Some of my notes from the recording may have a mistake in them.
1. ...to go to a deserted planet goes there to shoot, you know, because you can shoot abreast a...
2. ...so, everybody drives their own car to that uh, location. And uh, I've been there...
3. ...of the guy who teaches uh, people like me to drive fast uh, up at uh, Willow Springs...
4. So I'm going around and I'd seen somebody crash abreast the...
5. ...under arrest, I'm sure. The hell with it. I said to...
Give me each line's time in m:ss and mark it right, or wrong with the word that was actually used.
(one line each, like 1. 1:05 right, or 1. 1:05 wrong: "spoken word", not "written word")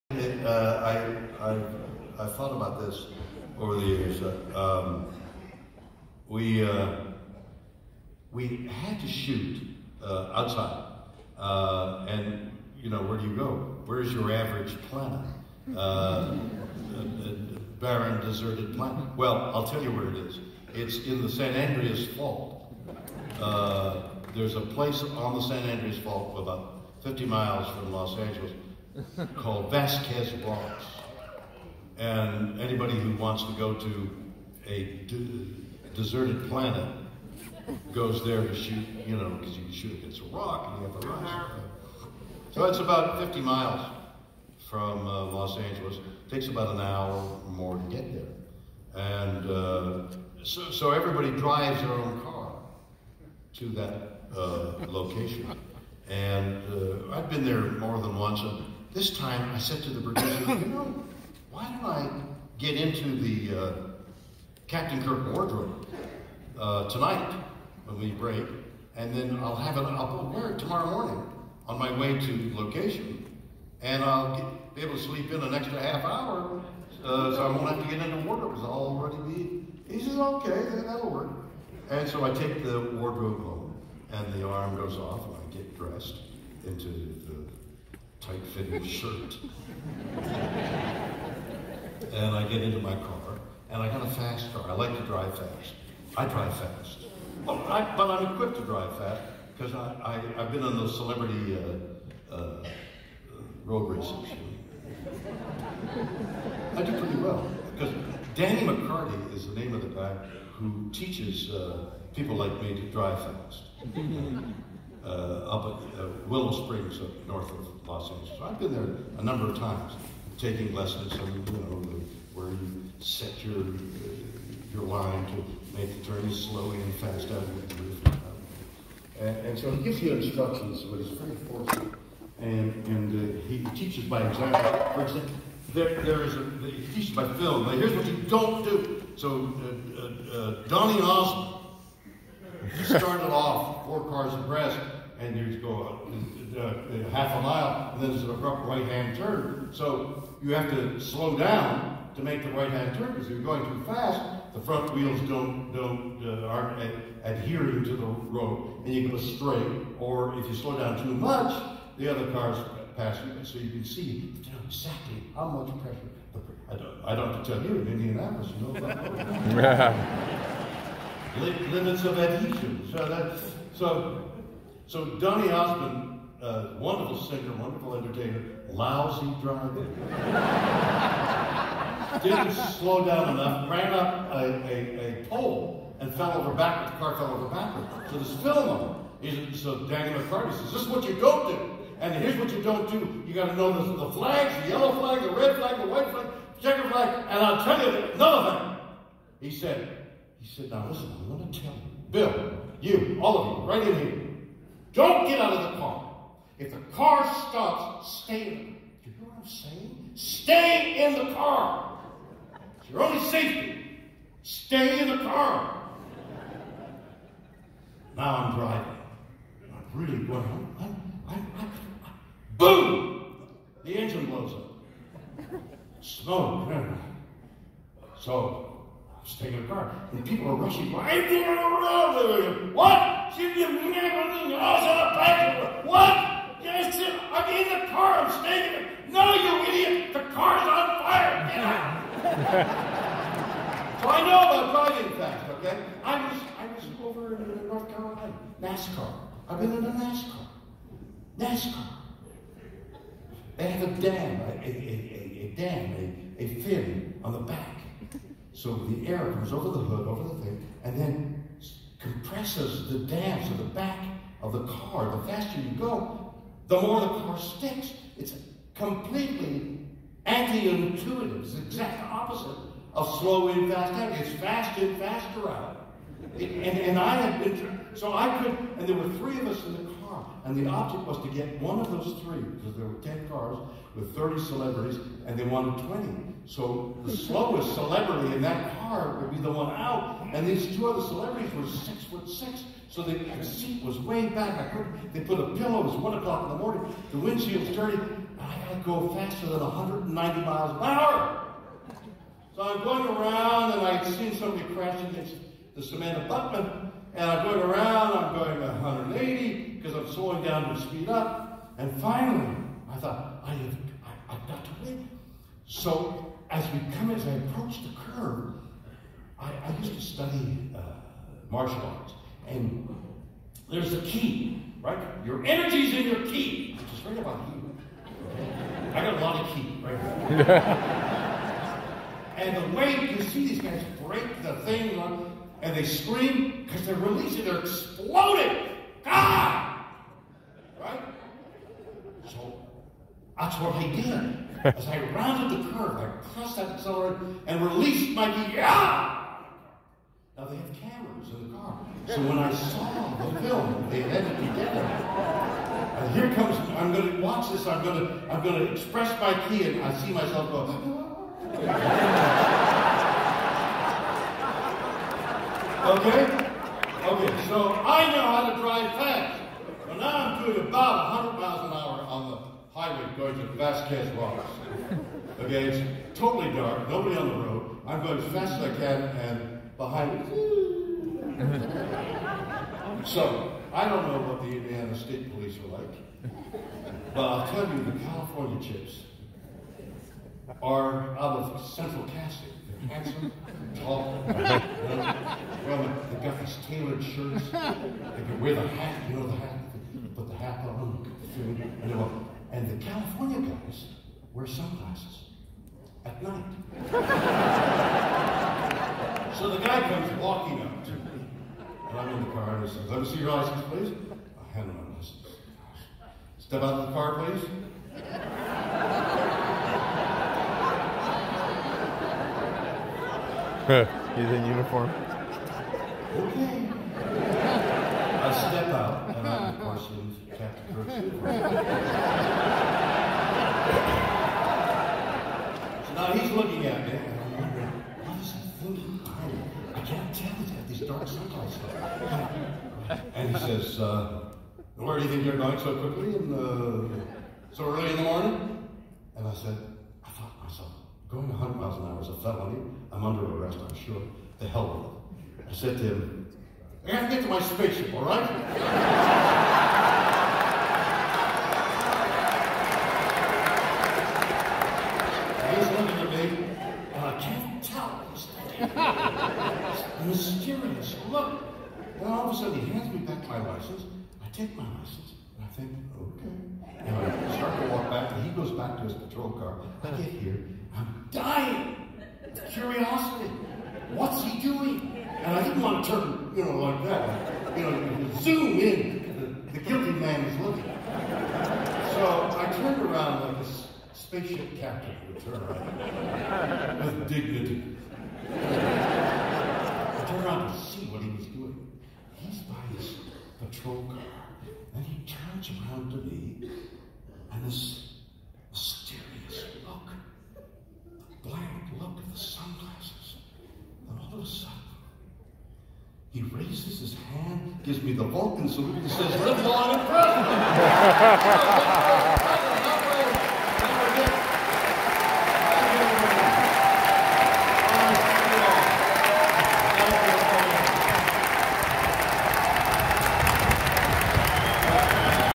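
1. 0:33 wrong: "against", not "abreast"
2. 0:50 right
3. 1:49 right
4. 5:02 wrong: "against", not "abreast"
5. 7:33 right.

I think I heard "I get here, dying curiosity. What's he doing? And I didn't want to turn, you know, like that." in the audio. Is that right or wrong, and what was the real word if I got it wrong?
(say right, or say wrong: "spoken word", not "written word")
right.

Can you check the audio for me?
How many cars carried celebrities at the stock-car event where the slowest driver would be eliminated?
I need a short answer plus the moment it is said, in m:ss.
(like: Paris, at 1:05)
10, at 4:43.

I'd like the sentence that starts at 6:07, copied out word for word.
Okay, so I know how to drive fast.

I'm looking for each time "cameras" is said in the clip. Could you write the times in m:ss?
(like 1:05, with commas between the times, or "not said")
5:50.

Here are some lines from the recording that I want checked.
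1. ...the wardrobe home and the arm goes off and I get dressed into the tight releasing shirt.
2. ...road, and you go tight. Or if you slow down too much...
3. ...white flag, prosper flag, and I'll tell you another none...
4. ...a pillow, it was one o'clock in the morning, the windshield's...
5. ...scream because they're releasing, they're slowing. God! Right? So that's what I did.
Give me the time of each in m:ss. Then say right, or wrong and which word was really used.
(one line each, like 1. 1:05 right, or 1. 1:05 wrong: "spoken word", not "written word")
1. 1:22 wrong: "fitting", not "releasing"
2. 2:38 wrong: "straight", not "tight"
3. 3:15 wrong: "checker", not "prosper"
4. 4:55 right
5. 5:35 wrong: "exploding", not "slowing".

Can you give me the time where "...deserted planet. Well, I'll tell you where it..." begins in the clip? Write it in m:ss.
0:18.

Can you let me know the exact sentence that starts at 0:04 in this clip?
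Uh, um, we, uh, we had to shoot uh, outside.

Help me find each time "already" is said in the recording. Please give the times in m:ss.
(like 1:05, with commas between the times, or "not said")
1:18.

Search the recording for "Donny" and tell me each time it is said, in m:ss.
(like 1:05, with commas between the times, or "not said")
2:20, 2:55.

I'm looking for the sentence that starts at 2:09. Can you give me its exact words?
And, and so he gives you instructions, but he's very forceful.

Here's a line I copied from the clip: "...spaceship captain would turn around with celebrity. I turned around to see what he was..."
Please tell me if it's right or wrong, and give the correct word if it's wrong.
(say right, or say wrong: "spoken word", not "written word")
wrong: "dignity", not "celebrity".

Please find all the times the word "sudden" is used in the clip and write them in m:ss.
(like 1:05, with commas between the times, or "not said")
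7:52.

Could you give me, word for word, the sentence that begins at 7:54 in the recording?
I take my license, and I think, okay.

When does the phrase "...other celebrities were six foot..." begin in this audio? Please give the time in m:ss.
4:50.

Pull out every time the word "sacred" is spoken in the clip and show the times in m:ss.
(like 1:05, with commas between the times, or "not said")
not said.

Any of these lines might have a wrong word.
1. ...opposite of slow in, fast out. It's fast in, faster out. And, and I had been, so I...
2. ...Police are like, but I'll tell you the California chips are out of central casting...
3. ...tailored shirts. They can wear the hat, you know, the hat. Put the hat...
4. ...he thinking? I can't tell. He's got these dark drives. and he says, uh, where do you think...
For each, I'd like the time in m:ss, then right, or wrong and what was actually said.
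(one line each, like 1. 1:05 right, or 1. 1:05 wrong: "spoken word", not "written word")
1. 4:32 right
2. 6:25 right
3. 6:36 right
4. 7:18 wrong: "circles", not "drives".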